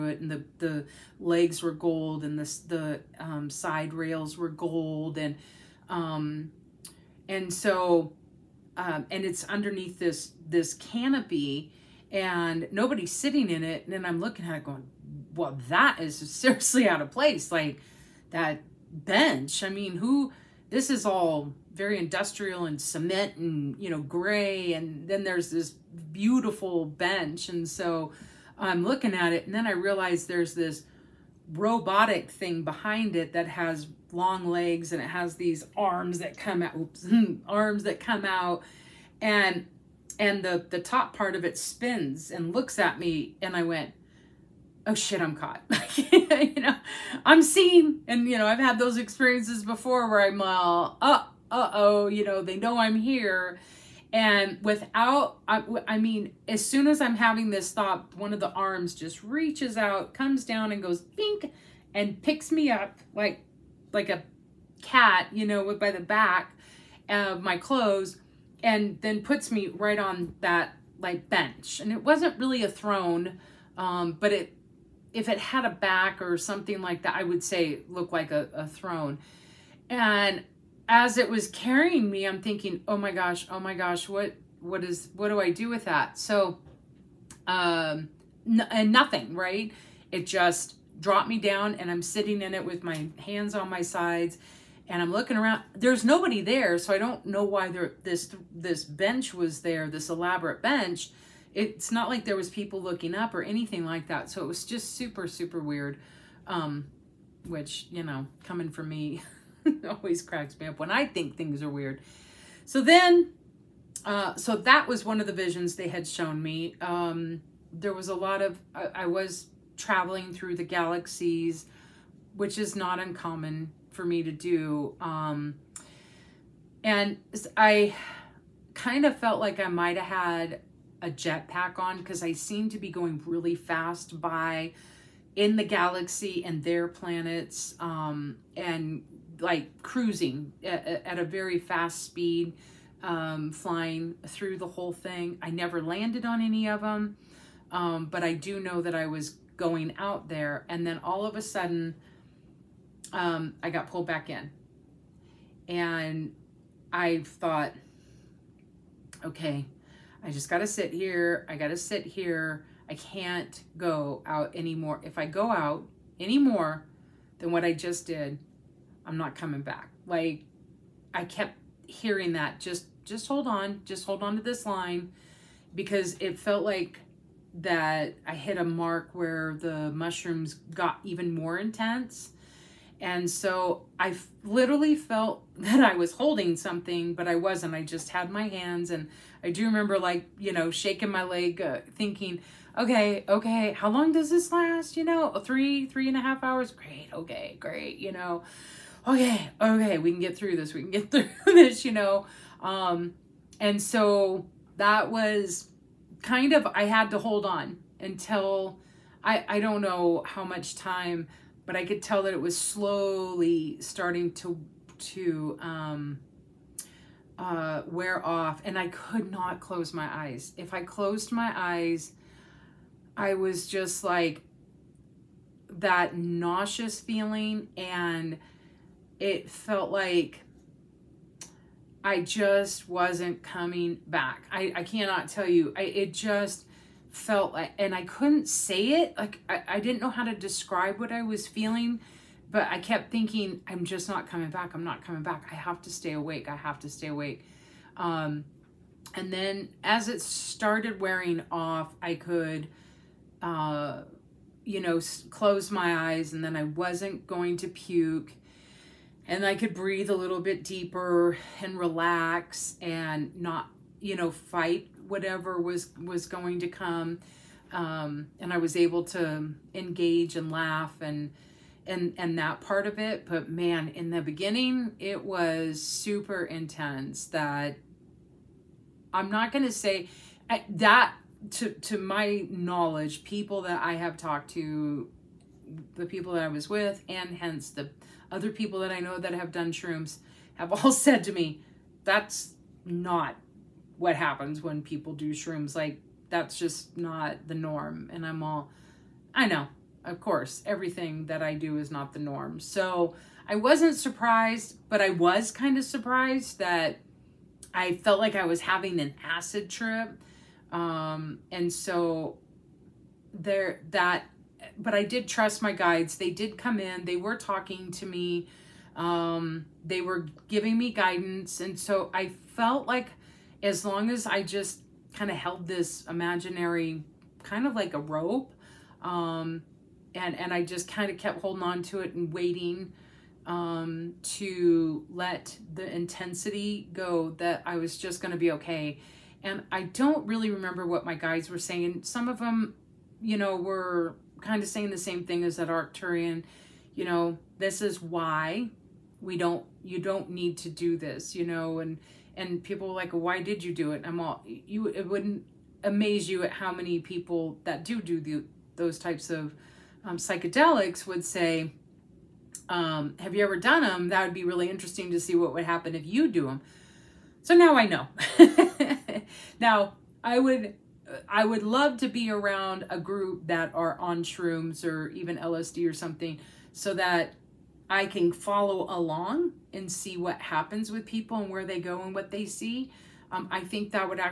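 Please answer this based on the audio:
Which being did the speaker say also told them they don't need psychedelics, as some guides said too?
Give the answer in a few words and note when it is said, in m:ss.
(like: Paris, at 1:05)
That Arcturian, at 5:45.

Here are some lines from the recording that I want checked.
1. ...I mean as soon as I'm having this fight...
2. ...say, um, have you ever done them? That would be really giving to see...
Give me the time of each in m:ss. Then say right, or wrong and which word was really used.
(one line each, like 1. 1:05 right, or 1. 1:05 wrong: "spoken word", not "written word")
1. 0:55 wrong: "thought", not "fight"
2. 6:01 wrong: "interesting", not "giving".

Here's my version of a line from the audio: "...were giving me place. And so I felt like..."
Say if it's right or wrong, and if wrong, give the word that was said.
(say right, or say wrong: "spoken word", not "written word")
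wrong: "guidance", not "place".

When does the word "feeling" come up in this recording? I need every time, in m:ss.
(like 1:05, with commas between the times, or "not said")
3:46, 4:01.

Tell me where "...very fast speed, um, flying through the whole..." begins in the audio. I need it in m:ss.
2:21.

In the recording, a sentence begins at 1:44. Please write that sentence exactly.
So it was just super super weird.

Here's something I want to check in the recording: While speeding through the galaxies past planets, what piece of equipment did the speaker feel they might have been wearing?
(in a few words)
Jetpack.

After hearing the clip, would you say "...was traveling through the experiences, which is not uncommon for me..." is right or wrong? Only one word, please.
wrong.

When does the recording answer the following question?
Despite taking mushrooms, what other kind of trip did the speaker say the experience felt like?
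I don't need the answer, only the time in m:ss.
5:09.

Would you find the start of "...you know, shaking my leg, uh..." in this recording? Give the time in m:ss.
3:10.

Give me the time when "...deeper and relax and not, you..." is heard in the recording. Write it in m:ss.
4:20.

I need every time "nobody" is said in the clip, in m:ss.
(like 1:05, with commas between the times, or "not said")
0:12, 1:36.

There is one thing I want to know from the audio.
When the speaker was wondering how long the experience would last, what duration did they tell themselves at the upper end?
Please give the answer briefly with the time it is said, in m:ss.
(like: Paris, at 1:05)
3 and a half hours, at 3:15.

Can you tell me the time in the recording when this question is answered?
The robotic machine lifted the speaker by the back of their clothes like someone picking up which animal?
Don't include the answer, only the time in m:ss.
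1:03.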